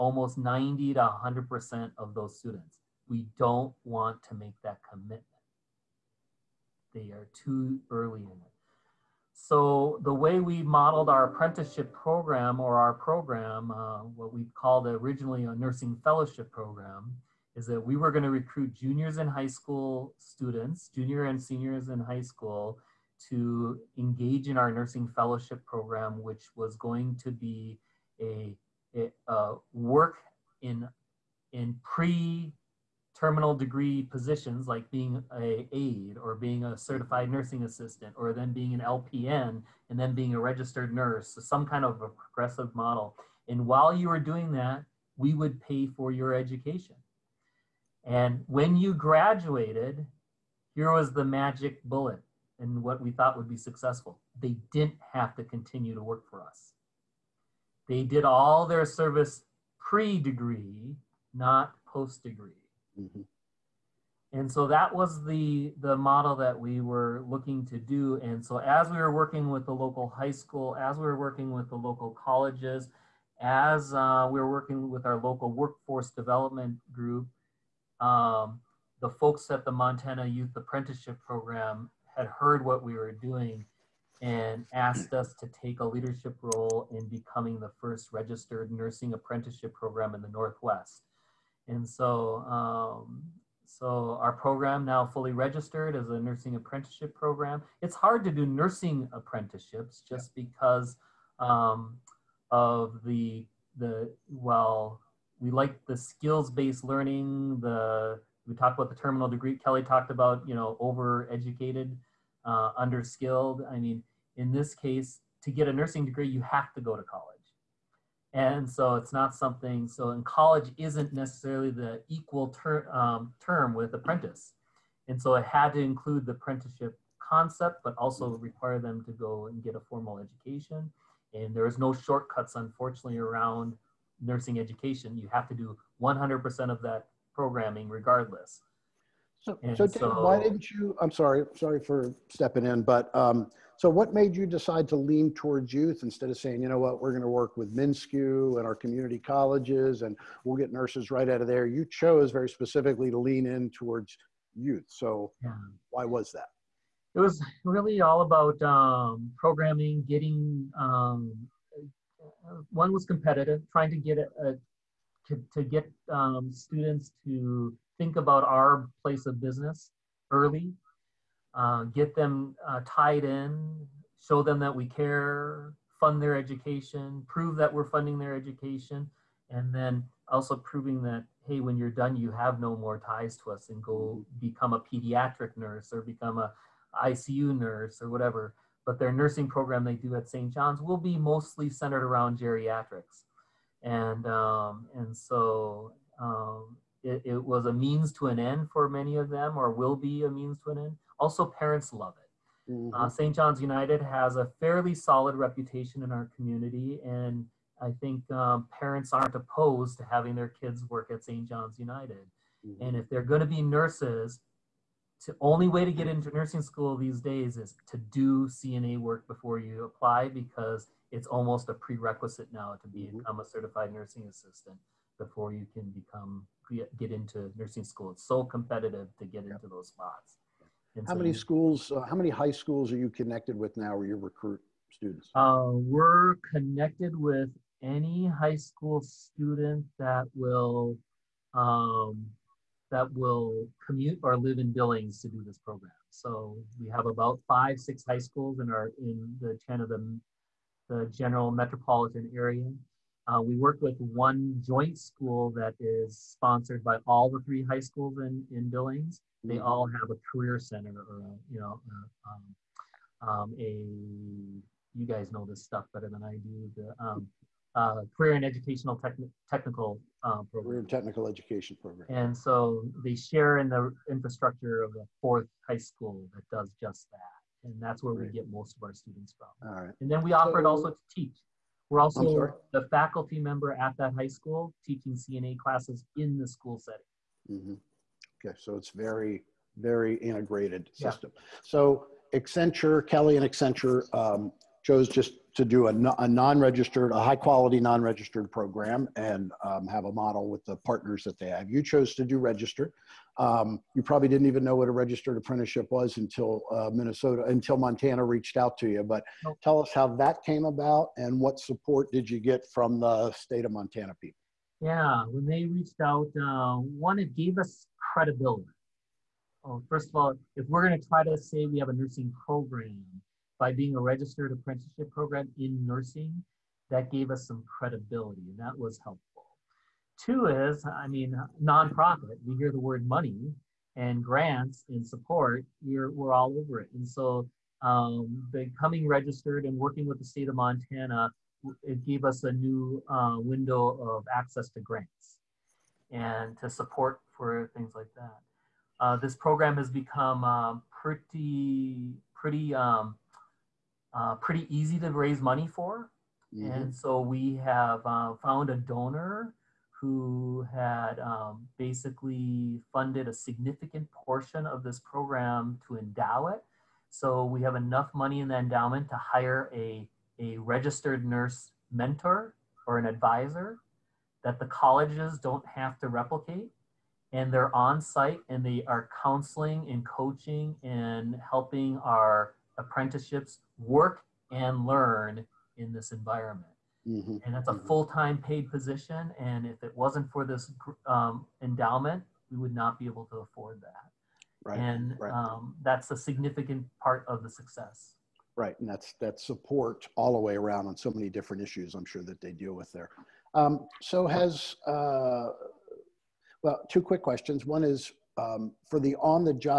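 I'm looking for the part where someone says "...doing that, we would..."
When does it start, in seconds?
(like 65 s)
44 s.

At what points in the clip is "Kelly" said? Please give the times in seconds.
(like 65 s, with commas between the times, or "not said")
109 s, 293 s.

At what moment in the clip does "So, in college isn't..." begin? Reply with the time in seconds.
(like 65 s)
119 s.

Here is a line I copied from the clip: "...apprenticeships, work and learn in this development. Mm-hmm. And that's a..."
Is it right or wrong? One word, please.
wrong.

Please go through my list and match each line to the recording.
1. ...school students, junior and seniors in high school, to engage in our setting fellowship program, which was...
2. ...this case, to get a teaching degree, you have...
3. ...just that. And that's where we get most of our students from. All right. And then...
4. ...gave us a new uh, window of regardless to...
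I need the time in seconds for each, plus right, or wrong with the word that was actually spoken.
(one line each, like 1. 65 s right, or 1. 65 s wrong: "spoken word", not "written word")
1. 19 s wrong: "nursing", not "setting"
2. 114 s wrong: "nursing", not "teaching"
3. 276 s right
4. 342 s wrong: "access", not "regardless".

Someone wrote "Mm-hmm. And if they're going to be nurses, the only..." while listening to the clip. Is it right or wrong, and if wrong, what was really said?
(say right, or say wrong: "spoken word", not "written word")
right.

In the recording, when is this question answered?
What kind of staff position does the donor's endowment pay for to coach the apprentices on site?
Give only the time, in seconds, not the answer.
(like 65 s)
370 s.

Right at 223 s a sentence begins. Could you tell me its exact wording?
become a certified nursing assistant before you can become get into nursing school.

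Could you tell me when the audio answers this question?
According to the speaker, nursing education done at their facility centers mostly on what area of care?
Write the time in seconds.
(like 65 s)
192 s.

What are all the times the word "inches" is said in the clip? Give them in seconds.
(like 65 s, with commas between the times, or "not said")
not said.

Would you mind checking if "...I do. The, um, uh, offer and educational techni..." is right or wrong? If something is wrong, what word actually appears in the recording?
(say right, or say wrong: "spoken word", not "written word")
wrong: "career", not "offer".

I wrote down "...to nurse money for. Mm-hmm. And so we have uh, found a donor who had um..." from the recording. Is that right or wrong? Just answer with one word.
wrong.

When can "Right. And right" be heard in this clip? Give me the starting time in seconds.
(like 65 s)
394 s.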